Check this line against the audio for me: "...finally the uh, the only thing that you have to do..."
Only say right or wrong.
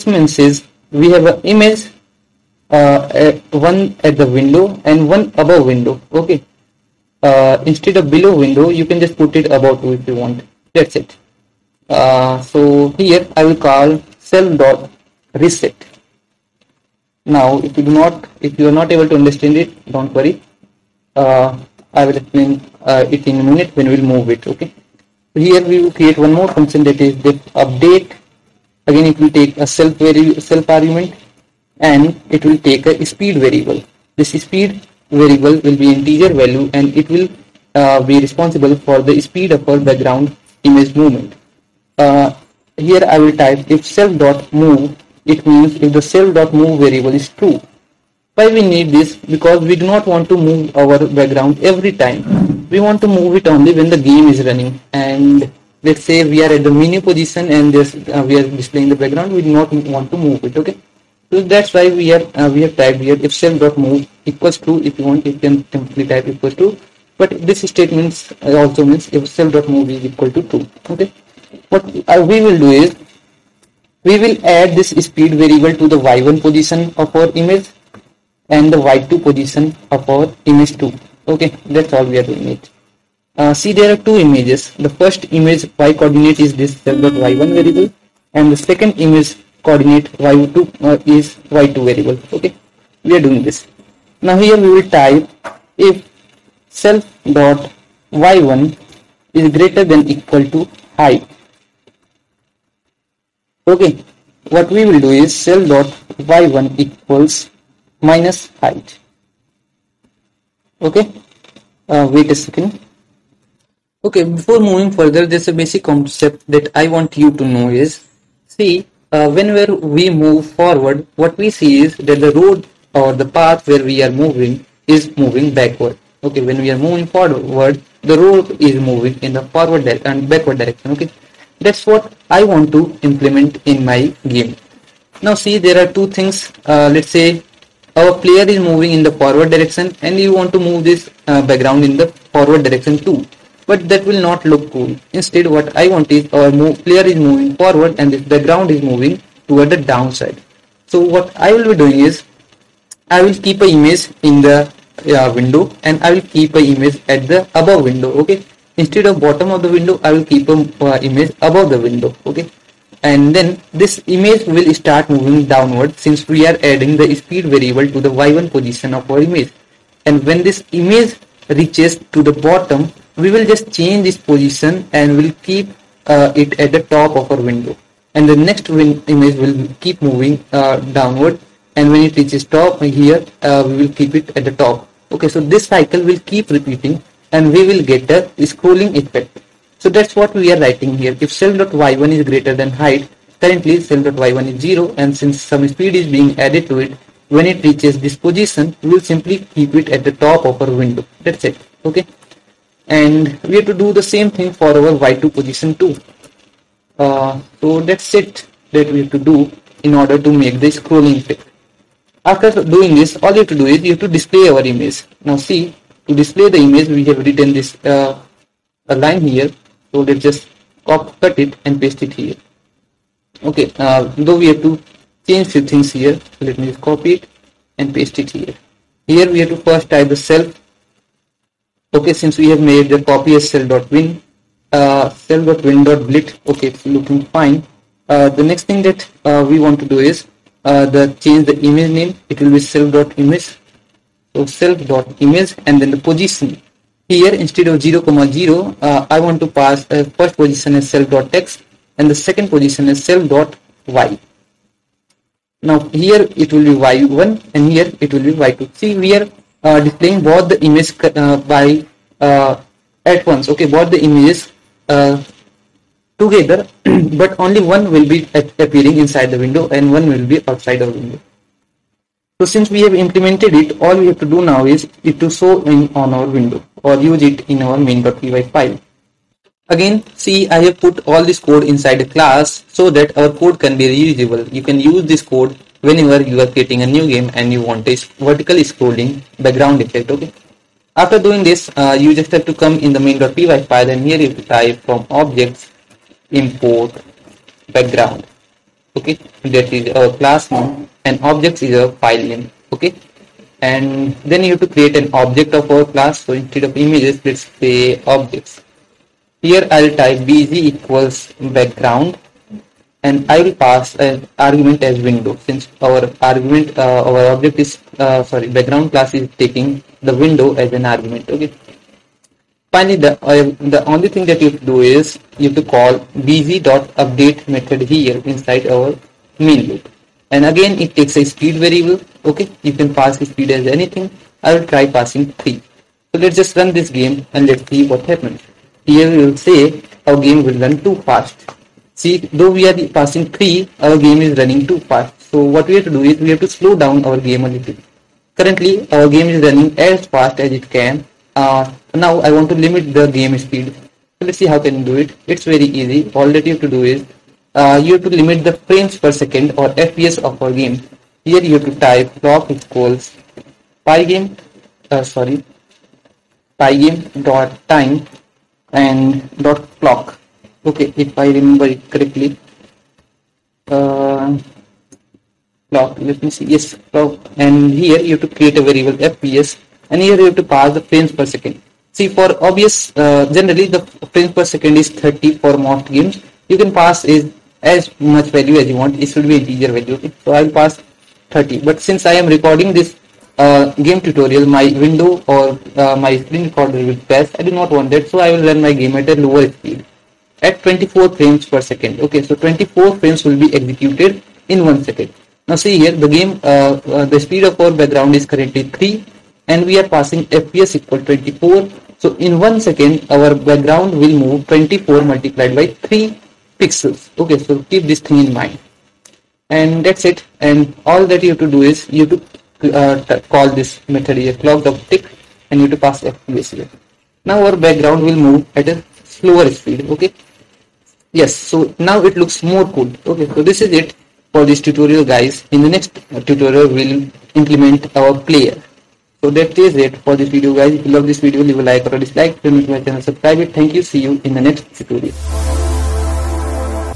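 right.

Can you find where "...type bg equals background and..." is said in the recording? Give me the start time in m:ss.
5:10.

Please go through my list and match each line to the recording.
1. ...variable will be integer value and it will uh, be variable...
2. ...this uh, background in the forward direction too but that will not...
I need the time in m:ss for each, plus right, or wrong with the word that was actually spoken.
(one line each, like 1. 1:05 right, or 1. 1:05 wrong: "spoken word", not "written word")
1. 0:35 wrong: "responsible", not "variable"
2. 2:20 right.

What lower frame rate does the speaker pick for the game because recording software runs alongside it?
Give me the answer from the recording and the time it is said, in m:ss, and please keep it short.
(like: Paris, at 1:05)
24, at 6:40.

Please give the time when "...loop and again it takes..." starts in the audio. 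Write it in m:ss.
5:29.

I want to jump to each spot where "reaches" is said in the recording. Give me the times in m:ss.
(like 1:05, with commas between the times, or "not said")
2:51, 3:02, 3:17.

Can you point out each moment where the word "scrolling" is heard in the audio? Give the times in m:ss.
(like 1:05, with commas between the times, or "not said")
3:08, 3:30, 4:48.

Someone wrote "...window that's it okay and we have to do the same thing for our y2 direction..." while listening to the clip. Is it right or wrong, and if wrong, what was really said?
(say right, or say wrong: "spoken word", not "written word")
wrong: "position", not "direction".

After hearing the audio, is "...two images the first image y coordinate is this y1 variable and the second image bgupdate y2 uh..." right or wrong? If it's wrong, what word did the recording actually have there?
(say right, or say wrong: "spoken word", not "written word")
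wrong: "coordinate", not "bgupdate".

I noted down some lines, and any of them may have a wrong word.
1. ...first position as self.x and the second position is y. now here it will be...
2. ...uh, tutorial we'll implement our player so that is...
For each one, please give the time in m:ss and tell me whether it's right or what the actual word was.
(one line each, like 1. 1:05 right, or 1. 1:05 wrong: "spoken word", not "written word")
1. 4:10 right
2. 7:16 right.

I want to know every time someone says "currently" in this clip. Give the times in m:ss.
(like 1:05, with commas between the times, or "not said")
3:13, 5:48, 6:48.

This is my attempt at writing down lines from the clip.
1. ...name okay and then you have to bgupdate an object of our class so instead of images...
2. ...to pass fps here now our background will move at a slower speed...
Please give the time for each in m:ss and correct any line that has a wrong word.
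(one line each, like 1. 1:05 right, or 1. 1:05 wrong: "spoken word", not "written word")
1. 5:02 wrong: "create", not "bgupdate"
2. 7:05 right.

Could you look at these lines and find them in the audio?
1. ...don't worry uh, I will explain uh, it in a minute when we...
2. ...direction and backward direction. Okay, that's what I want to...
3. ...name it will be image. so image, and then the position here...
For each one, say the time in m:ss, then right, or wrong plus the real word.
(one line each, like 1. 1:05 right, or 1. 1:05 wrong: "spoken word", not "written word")
1. 0:19 right
2. 2:09 right
3. 4:01 right.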